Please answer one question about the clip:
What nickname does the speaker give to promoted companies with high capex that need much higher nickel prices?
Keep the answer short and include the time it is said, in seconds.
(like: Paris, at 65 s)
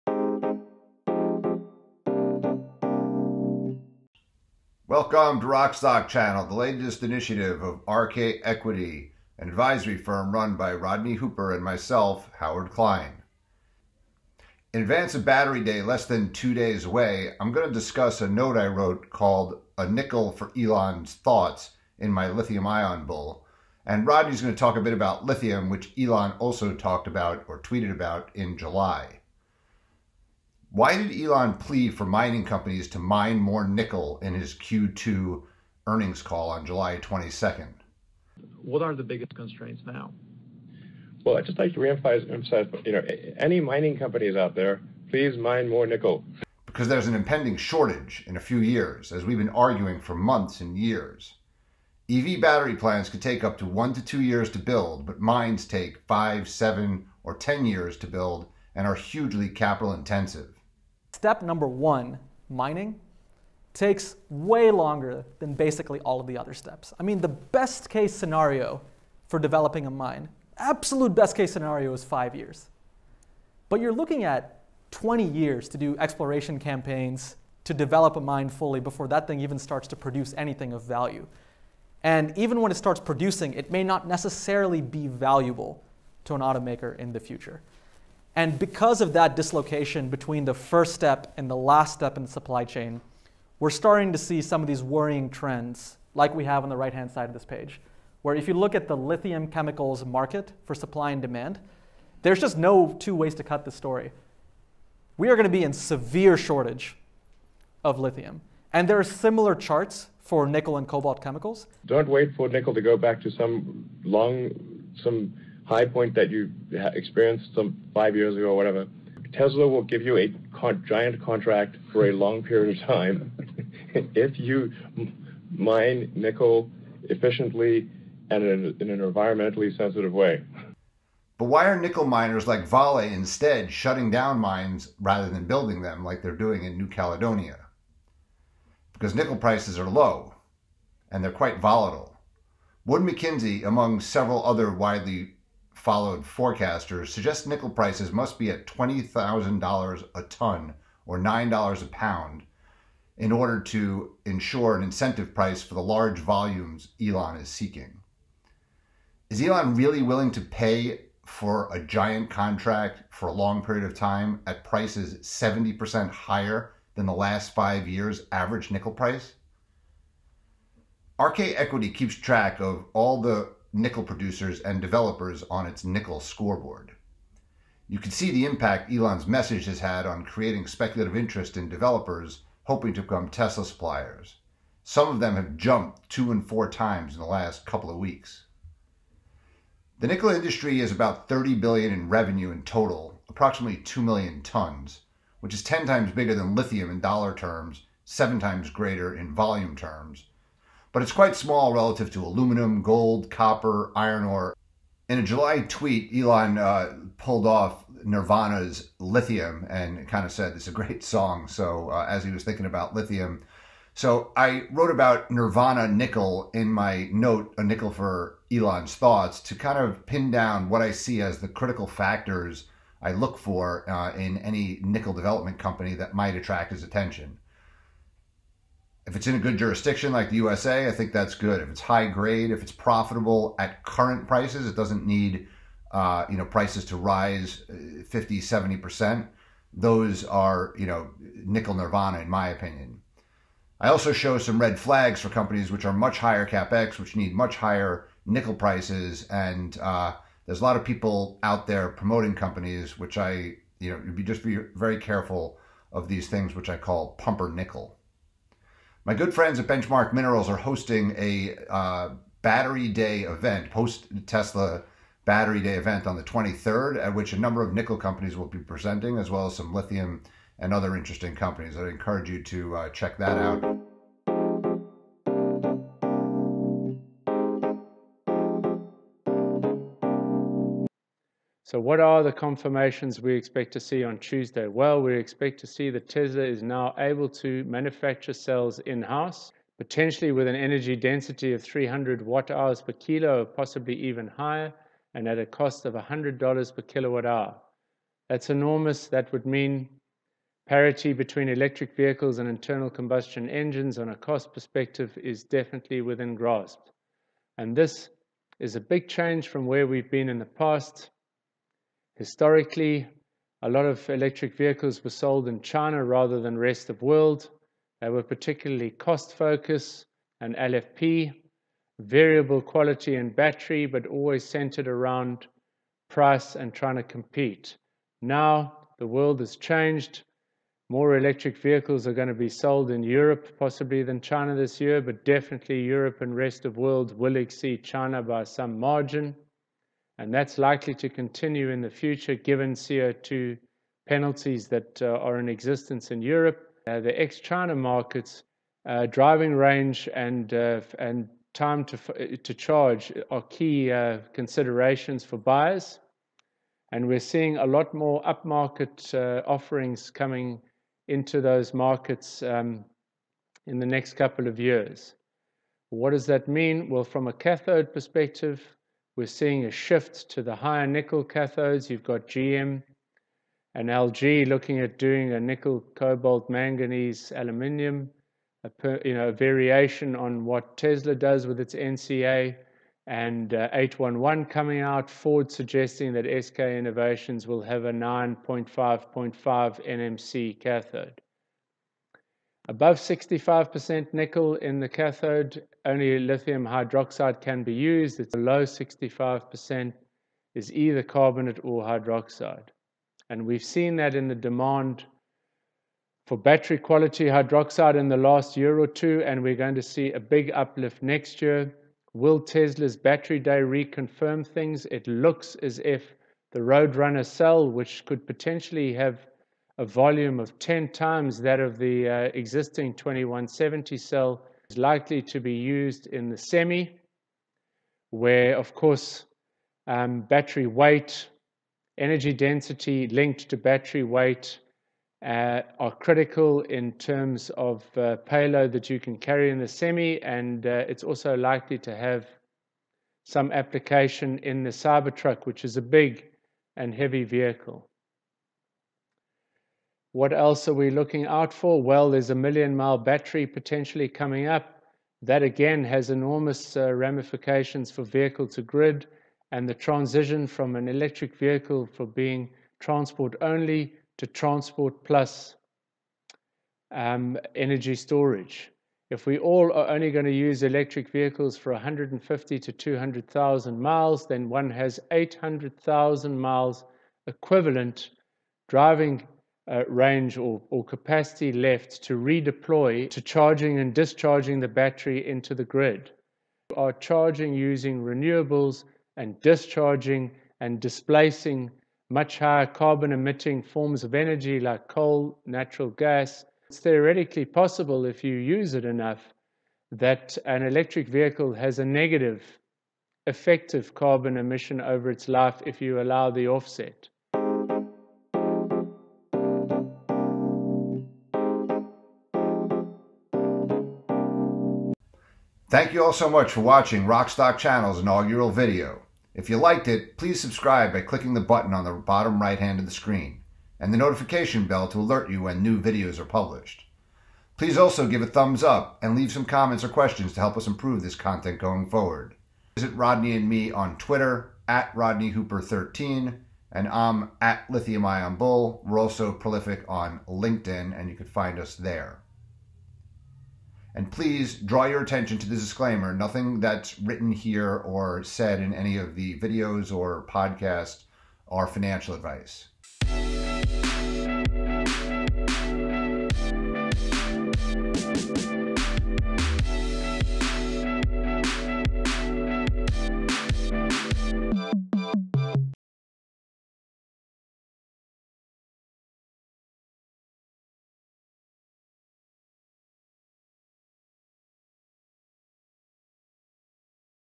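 pumper nickel, at 257 s.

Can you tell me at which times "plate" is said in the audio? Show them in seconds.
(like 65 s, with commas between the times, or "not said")
not said.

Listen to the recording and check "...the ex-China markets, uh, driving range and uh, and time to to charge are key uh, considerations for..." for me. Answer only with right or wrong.
right.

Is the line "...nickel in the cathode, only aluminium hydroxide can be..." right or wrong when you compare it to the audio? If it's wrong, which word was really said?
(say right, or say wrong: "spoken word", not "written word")
wrong: "lithium", not "aluminium".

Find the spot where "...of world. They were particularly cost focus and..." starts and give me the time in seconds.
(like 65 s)
316 s.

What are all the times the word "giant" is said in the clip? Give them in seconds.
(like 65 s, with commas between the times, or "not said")
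120 s, 161 s.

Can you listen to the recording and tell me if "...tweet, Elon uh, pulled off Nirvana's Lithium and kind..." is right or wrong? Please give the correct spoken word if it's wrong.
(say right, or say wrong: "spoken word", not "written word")
right.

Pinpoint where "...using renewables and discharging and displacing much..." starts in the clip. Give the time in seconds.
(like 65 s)
487 s.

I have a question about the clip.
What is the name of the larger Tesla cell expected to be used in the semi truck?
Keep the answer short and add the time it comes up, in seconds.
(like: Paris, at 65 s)
Roadrunner, at 416 s.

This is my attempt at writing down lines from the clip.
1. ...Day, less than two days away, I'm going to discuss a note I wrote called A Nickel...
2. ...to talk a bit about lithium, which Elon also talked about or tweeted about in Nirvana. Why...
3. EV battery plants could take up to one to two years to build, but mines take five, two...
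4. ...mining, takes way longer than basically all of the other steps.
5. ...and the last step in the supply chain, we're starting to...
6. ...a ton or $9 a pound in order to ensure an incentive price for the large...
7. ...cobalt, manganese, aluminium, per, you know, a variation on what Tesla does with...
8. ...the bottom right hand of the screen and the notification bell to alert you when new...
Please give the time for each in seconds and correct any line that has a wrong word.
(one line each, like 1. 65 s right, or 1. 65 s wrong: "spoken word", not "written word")
1. 15 s right
2. 24 s wrong: "July", not "Nirvana"
3. 52 s wrong: "seven", not "two"
4. 62 s right
5. 91 s right
6. 150 s right
7. 375 s right
8. 521 s right.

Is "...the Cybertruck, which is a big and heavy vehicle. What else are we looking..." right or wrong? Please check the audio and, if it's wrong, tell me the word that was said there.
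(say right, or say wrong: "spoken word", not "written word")
right.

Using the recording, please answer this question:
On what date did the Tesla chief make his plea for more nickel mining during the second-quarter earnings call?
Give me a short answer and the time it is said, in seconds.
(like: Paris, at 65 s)
July 22nd, at 36 s.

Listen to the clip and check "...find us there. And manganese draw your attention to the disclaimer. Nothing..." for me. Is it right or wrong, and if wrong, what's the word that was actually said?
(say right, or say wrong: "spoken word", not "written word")
wrong: "please", not "manganese".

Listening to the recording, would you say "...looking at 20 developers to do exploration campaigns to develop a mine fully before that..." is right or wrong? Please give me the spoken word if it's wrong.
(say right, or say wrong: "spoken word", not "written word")
wrong: "years", not "developers".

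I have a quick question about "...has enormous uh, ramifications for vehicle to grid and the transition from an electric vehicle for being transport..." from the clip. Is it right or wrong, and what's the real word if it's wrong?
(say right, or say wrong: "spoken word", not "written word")
right.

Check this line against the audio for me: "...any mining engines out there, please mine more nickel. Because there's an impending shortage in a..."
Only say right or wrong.
wrong.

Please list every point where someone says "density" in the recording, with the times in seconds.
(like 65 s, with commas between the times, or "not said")
290 s, 432 s.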